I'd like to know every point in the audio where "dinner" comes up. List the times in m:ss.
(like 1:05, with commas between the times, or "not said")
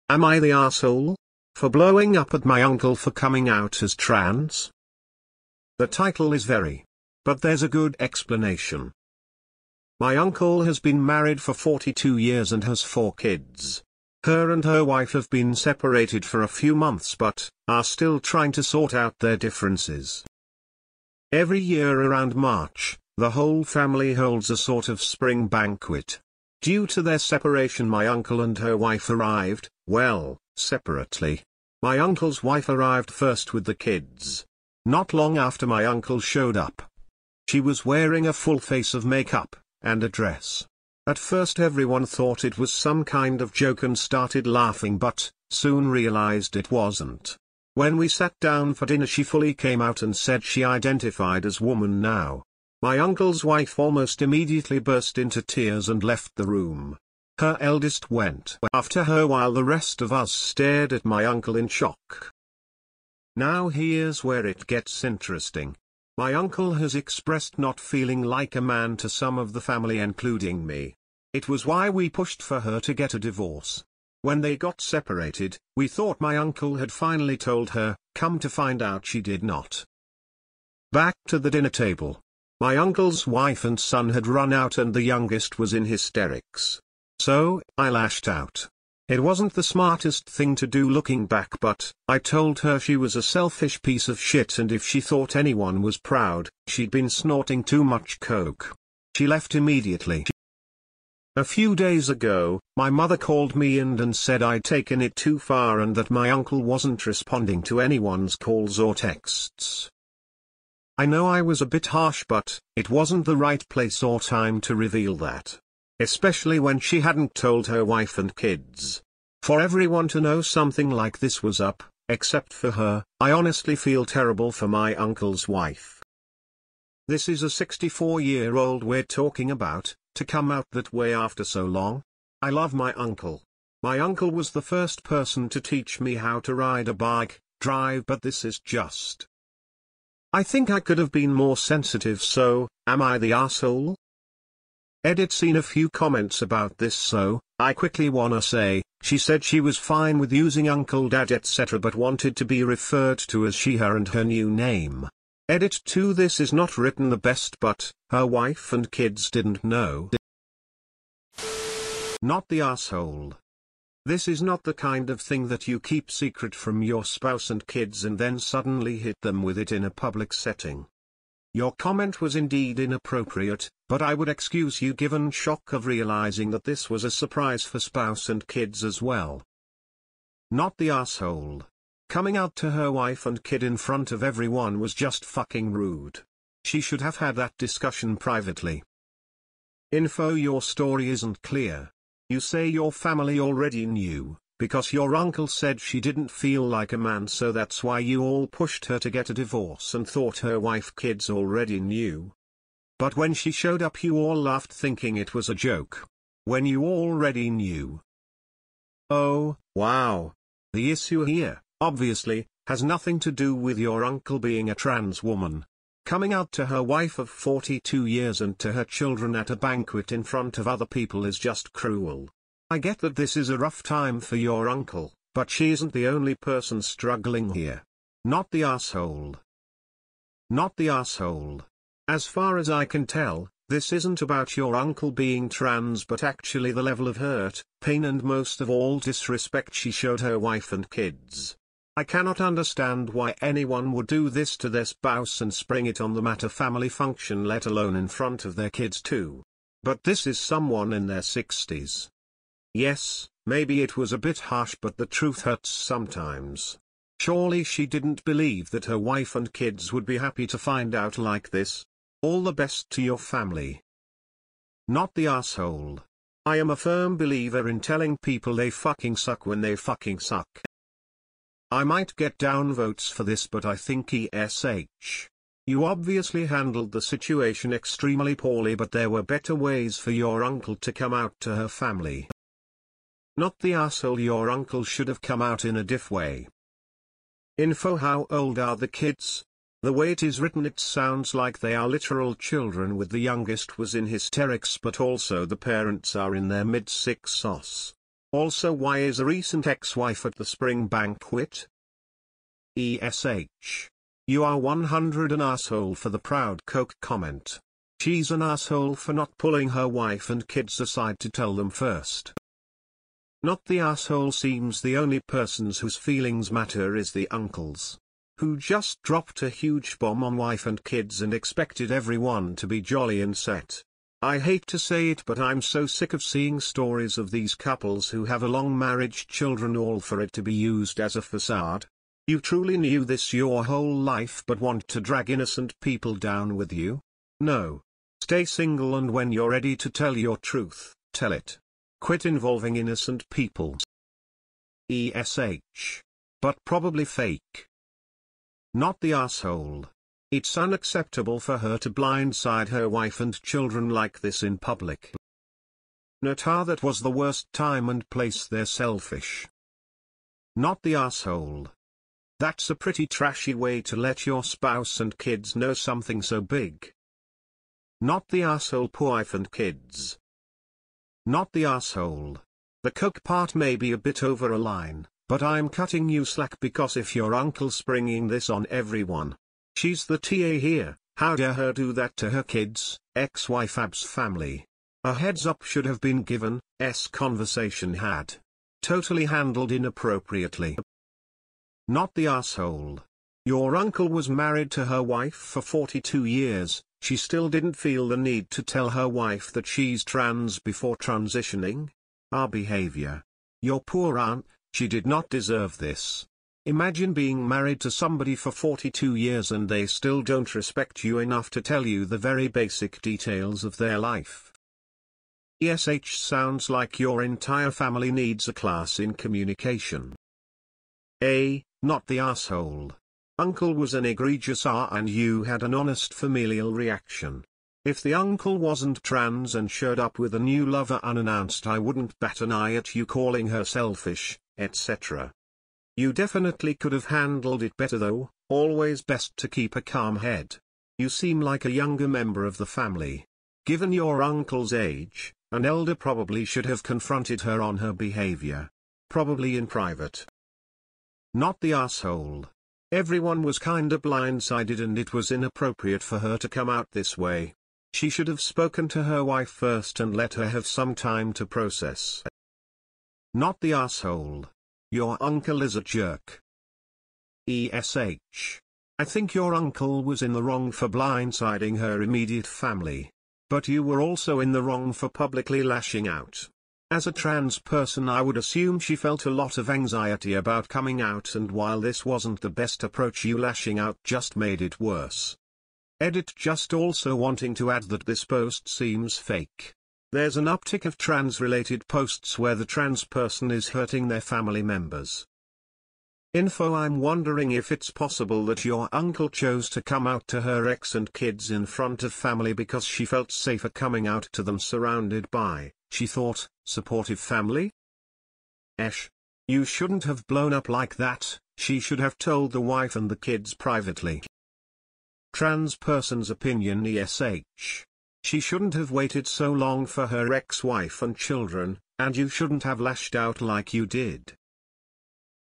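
0:48, 1:21.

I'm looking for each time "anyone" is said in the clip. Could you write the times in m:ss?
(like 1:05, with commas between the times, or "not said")
1:35, 1:47, 4:03.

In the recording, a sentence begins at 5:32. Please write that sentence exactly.
You truly knew this your whole life but want to drag innocent people down with you?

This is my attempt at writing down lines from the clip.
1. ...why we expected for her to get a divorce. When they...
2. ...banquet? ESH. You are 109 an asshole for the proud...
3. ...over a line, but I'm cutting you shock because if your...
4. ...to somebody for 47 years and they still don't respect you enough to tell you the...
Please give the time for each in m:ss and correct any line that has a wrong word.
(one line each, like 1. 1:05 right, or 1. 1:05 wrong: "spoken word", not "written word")
1. 1:11 wrong: "pushed", not "expected"
2. 5:00 wrong: "100", not "109"
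3. 6:14 wrong: "slack", not "shock"
4. 6:47 wrong: "42", not "47".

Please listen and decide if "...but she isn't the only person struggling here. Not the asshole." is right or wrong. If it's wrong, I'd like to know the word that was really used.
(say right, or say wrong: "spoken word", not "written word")
right.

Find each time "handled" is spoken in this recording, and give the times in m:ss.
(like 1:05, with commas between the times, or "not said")
4:36, 6:29, 7:17.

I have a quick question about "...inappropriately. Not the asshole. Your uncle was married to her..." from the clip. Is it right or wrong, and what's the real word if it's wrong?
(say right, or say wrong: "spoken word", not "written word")
right.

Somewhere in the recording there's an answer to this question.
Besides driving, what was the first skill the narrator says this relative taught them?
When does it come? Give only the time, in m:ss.
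2:16.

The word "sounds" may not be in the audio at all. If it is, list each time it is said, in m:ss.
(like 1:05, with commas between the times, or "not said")
4:50, 6:56.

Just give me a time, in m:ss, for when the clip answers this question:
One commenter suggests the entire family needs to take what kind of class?
6:59.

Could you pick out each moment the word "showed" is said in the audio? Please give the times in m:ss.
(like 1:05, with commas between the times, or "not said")
0:36, 3:23, 3:59, 7:09.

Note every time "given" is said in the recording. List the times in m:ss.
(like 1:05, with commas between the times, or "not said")
2:54, 6:26, 7:23.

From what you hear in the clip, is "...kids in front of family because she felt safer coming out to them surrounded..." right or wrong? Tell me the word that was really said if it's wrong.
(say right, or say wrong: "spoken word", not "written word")
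right.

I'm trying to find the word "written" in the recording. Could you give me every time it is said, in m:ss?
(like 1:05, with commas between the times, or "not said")
2:36, 4:50.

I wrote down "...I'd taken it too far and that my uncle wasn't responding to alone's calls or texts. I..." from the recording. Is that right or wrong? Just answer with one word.
wrong.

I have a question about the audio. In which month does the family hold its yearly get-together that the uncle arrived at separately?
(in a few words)
March.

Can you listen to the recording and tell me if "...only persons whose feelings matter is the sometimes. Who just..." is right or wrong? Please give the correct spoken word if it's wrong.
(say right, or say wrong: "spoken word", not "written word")
wrong: "uncles", not "sometimes".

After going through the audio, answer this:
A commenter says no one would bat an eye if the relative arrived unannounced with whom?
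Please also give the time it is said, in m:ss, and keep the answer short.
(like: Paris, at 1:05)
a new lover, at 7:10.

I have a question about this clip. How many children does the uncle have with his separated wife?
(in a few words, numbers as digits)
4.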